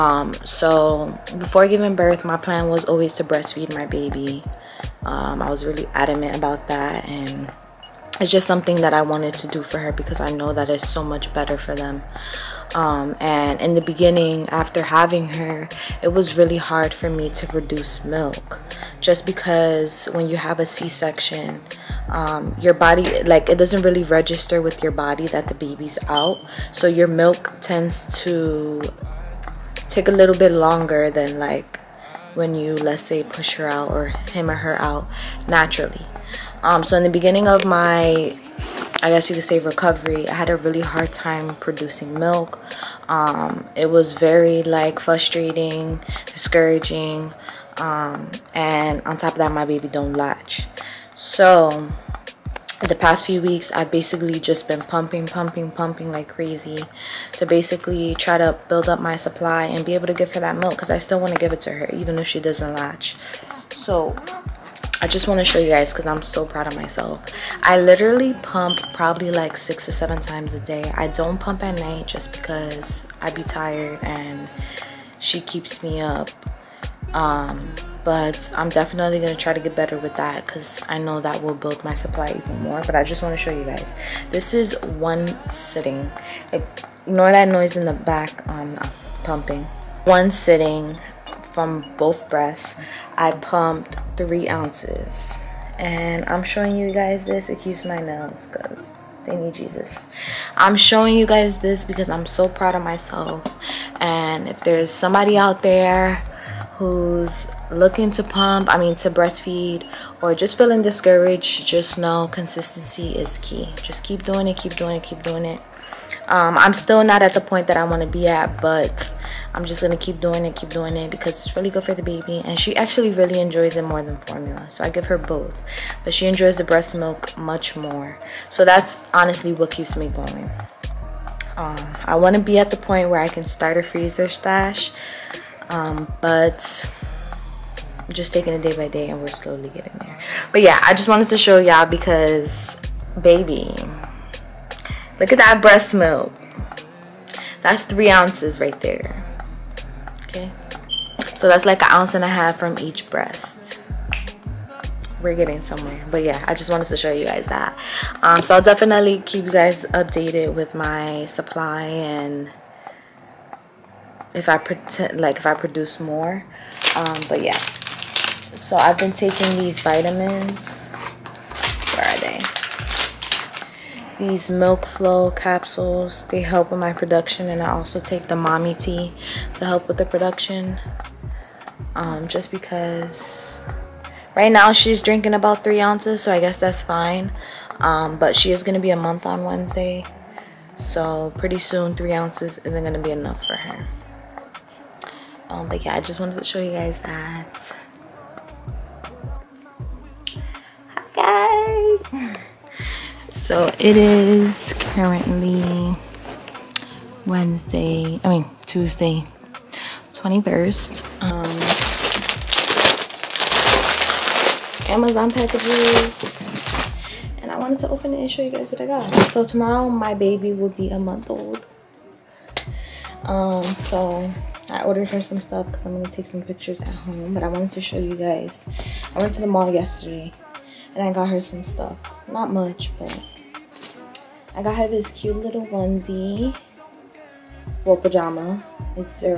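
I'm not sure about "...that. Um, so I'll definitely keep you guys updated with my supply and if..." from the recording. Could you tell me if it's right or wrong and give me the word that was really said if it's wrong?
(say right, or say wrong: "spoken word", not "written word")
right.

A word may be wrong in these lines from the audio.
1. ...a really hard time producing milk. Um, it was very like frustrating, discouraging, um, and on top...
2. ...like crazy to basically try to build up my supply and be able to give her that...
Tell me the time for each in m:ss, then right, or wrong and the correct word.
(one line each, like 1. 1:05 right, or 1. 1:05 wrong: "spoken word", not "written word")
1. 0:40 right
2. 0:56 right.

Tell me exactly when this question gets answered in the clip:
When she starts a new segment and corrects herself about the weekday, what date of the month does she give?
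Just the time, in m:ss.
3:30.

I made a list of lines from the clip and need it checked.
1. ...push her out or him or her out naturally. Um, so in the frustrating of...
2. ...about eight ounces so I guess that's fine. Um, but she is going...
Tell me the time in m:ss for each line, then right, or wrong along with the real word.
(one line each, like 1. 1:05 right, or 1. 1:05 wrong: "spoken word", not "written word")
1. 0:33 wrong: "beginning", not "frustrating"
2. 3:05 wrong: "three", not "eight".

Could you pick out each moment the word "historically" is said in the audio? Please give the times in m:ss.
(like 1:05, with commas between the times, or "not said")
not said.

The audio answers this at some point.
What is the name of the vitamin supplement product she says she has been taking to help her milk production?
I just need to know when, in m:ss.
2:54.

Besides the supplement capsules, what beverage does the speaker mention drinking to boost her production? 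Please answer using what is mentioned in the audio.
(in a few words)
mommy tea.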